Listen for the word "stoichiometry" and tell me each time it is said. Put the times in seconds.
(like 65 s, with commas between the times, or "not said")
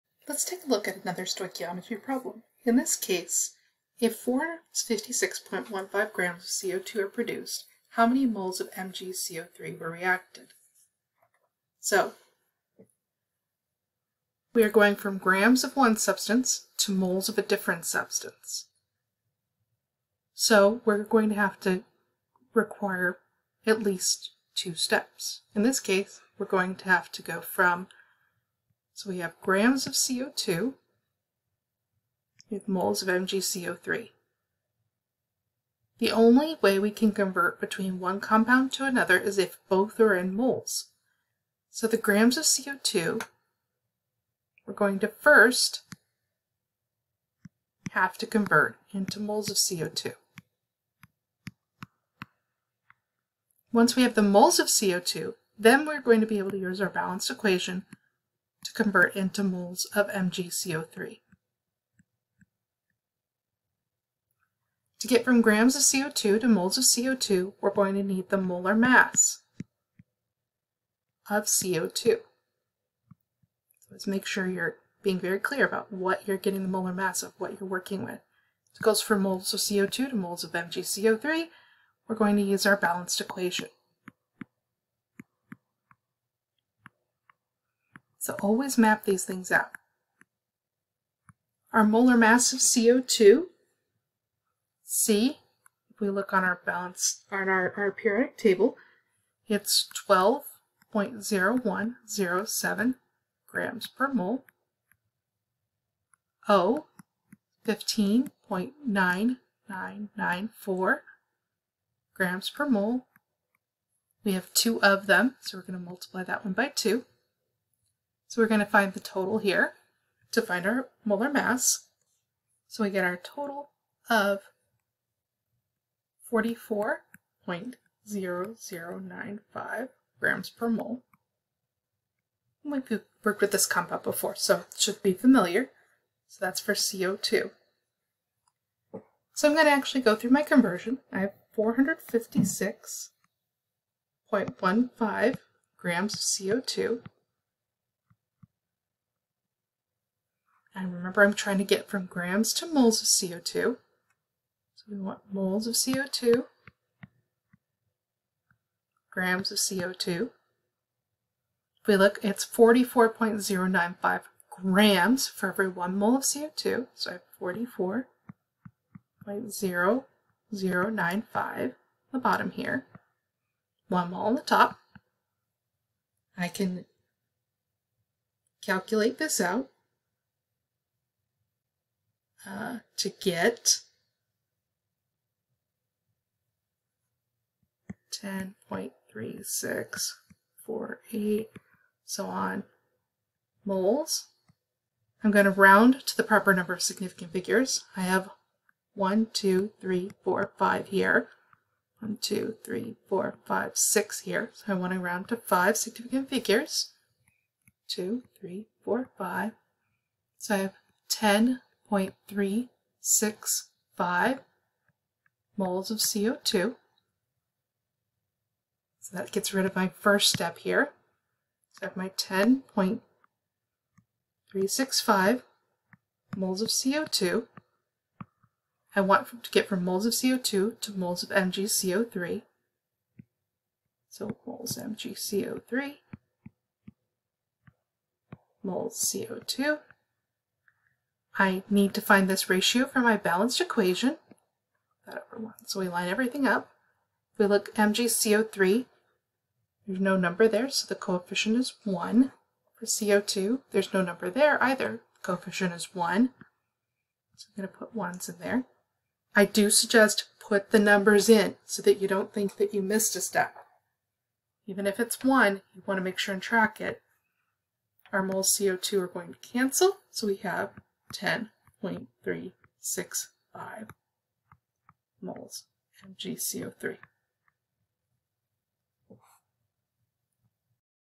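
1 s.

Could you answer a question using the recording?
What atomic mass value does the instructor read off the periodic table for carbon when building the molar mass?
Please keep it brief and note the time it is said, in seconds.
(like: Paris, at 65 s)
12.0107 grams per mole, at 100 s.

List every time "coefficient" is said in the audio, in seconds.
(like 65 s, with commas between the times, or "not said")
250 s, 255 s.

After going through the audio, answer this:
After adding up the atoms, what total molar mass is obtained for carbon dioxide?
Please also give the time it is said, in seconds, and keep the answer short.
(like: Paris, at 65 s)
44.0095 grams per mole, at 126 s.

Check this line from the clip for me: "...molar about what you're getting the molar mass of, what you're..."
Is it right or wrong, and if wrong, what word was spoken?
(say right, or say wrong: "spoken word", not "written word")
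wrong: "clear", not "molar".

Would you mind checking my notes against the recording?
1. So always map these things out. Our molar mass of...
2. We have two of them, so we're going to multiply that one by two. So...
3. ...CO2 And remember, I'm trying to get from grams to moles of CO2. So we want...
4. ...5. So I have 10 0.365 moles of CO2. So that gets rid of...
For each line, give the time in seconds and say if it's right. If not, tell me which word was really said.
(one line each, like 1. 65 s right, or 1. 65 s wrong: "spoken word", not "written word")
1. 88 s right
2. 114 s right
3. 146 s right
4. 209 s right.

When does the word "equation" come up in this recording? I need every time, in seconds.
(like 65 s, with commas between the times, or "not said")
57 s, 83 s, 243 s.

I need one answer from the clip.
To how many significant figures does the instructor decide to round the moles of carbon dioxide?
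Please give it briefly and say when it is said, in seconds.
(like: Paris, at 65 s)
5, at 205 s.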